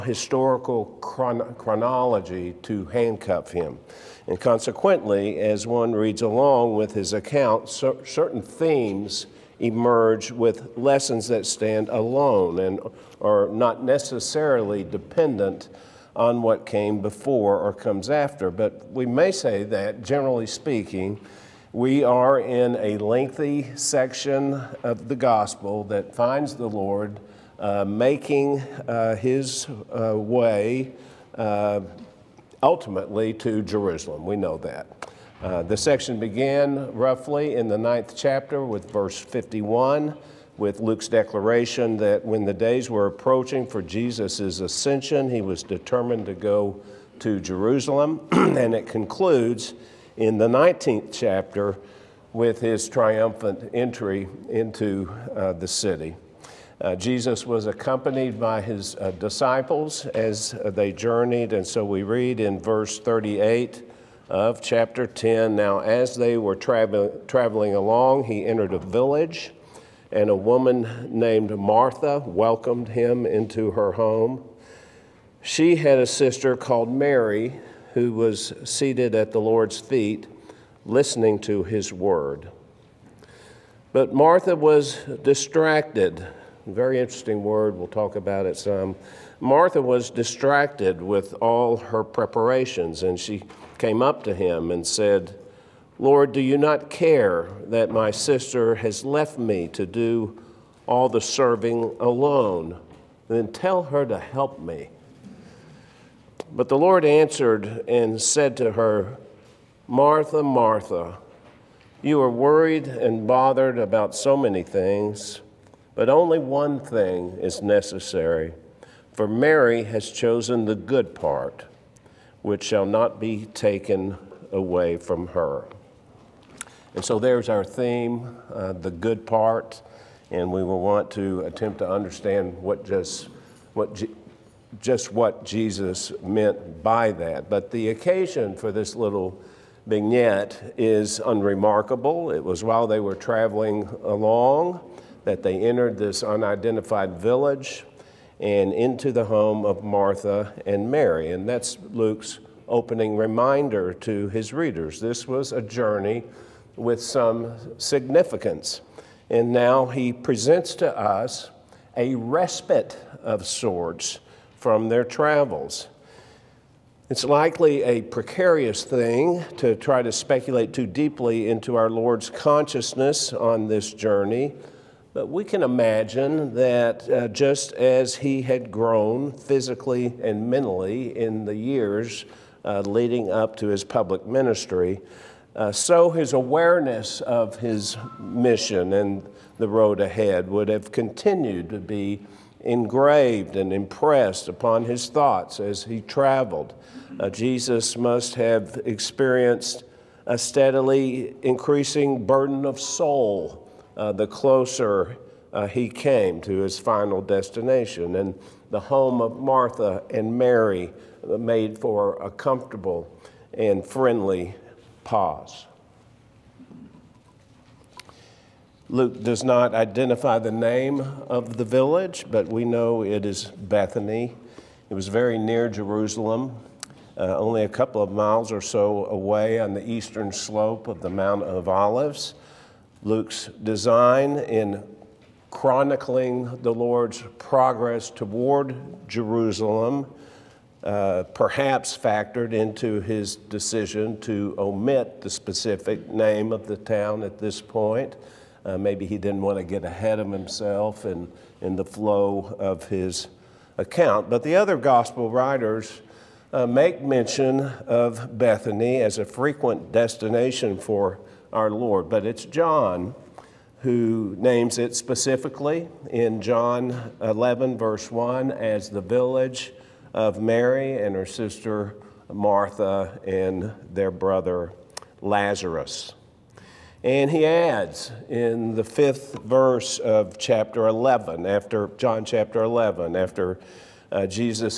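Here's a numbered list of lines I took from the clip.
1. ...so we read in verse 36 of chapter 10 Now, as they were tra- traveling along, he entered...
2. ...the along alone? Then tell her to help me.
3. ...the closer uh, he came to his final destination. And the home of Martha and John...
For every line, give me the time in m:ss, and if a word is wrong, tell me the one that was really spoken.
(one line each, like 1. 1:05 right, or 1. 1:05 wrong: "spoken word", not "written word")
1. 1:01 wrong: "38", not "36"
2. 1:41 wrong: "serving", not "along"
3. 3:24 wrong: "Mary", not "John".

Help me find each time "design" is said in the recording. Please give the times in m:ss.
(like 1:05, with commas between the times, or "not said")
3:53.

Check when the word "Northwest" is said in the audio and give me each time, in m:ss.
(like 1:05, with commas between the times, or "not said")
not said.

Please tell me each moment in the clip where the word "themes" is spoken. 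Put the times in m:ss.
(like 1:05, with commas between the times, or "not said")
0:08, 2:07.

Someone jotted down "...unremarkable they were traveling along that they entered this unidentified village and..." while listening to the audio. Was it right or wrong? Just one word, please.
wrong.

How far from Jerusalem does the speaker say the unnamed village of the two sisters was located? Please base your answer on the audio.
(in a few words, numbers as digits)
a couple of miles.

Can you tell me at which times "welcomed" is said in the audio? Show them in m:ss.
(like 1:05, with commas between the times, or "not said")
1:12.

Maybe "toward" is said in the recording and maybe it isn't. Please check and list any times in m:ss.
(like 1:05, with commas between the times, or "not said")
3:58.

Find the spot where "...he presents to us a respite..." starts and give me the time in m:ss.
2:39.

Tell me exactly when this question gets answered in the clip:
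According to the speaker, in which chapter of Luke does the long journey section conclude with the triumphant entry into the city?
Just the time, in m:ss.
0:50.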